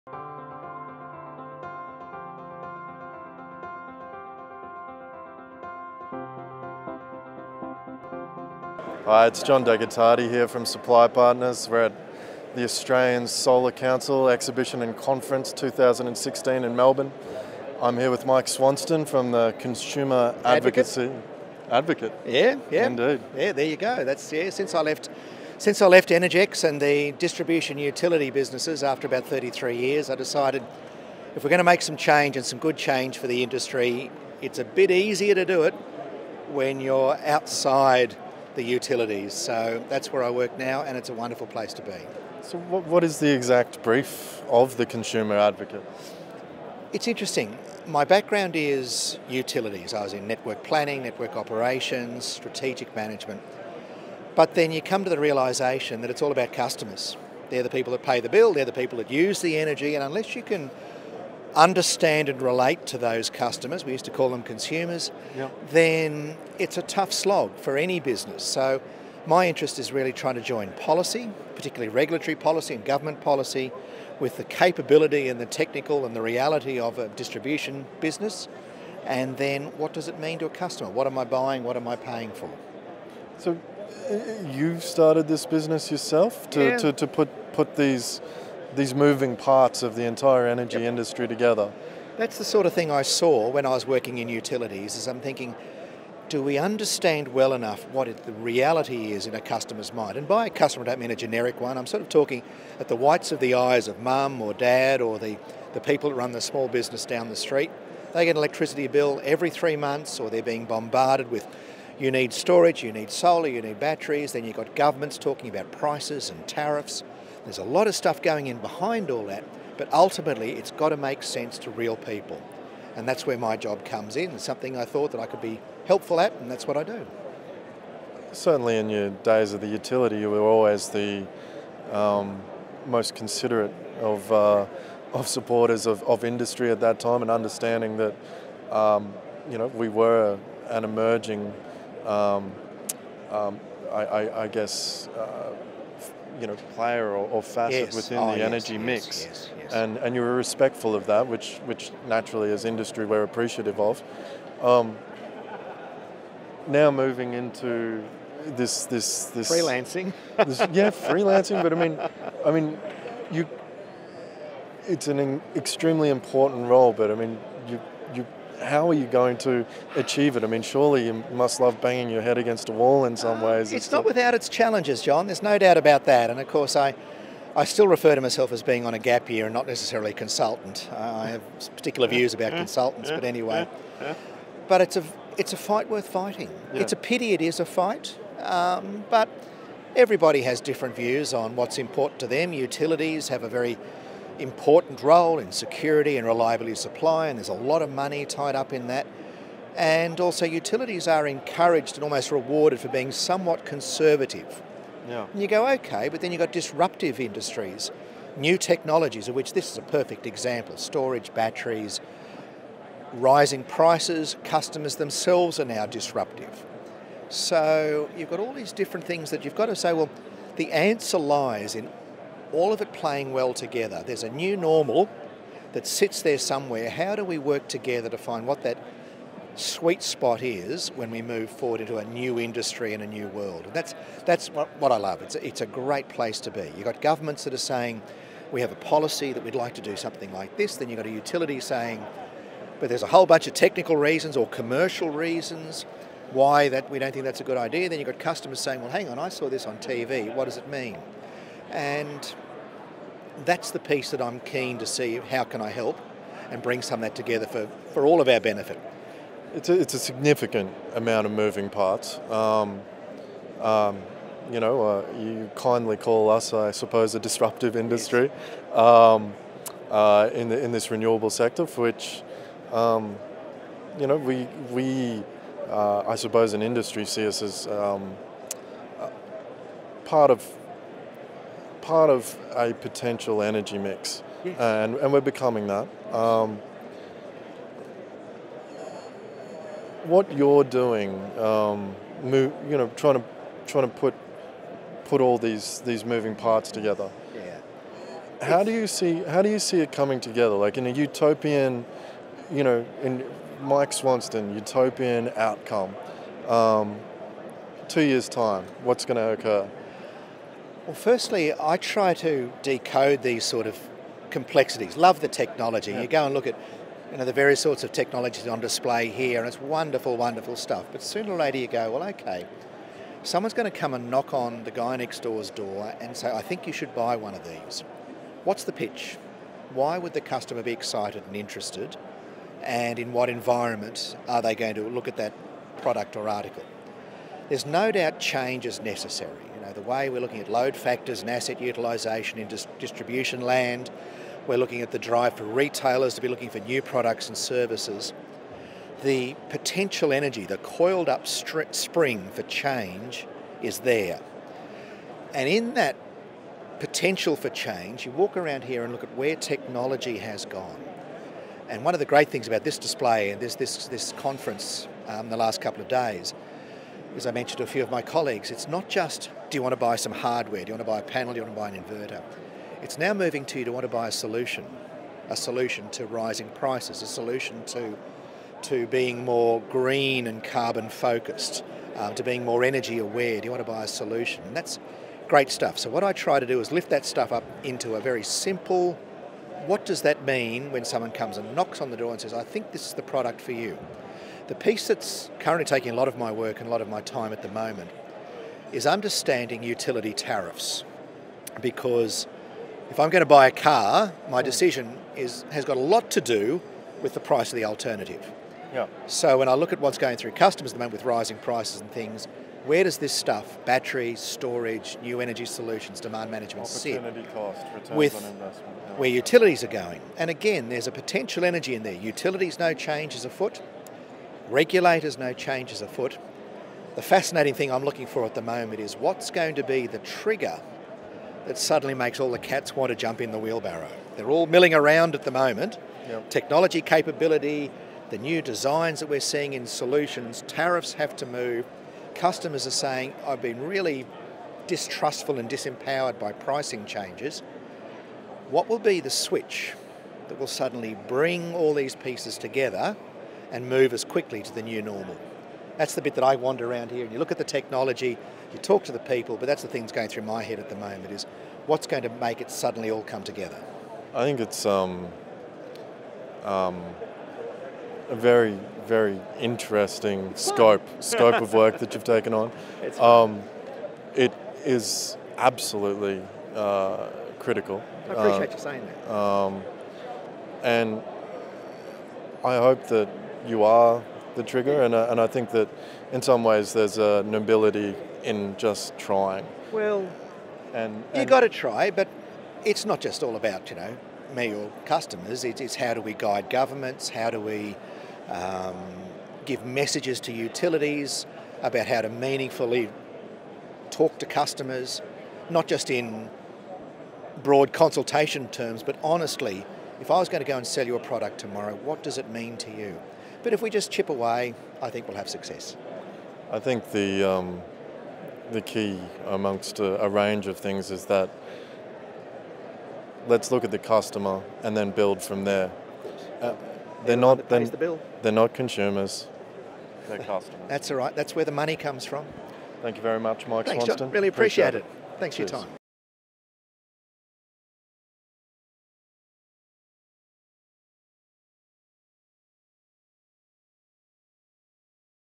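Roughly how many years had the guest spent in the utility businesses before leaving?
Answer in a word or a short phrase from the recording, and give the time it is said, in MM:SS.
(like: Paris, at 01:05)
33, at 00:29.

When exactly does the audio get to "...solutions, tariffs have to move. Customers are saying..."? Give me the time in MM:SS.
07:19.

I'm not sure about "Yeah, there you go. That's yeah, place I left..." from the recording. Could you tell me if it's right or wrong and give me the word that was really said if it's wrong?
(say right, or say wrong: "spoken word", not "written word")
wrong: "since", not "place".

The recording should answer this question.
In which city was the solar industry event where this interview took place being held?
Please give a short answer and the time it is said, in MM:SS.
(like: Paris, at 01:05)
Melbourne, at 00:16.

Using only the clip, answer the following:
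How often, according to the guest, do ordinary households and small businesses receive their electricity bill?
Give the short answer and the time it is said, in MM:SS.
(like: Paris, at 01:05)
every three months, at 01:49.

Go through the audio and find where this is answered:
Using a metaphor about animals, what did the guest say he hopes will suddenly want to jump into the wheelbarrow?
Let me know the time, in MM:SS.
07:12.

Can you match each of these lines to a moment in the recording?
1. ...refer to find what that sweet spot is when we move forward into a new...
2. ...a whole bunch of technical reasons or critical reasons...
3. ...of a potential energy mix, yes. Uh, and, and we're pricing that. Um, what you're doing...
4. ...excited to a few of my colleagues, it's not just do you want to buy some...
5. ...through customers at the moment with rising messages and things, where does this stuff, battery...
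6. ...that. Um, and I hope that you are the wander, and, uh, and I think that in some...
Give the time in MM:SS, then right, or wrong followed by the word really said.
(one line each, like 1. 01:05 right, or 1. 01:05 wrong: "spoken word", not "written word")
1. 03:47 wrong: "together", not "refer"
2. 04:03 wrong: "commercial", not "critical"
3. 04:42 wrong: "becoming", not "pricing"
4. 06:07 wrong: "mentioned", not "excited"
5. 06:50 wrong: "prices", not "messages"
6. 07:59 wrong: "trigger", not "wander".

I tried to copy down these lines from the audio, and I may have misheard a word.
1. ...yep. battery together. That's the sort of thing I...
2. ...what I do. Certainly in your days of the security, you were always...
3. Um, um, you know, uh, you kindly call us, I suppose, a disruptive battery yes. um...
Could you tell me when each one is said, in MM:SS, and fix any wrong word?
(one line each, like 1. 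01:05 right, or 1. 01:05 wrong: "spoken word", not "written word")
1. 01:30 wrong: "industry", not "battery"
2. 02:06 wrong: "utility", not "security"
3. 04:22 wrong: "industry", not "battery".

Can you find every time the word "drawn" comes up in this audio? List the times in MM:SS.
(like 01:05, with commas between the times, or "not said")
not said.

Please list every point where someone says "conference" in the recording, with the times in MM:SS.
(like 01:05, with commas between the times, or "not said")
00:14, 06:04.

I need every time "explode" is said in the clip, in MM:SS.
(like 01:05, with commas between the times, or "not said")
not said.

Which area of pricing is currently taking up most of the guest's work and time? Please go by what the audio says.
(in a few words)
utility tariffs.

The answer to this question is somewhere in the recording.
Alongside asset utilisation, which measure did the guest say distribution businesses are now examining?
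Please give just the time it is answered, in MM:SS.
05:40.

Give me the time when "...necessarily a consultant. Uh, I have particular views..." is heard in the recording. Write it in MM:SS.
02:59.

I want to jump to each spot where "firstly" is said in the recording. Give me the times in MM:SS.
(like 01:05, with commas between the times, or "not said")
05:10.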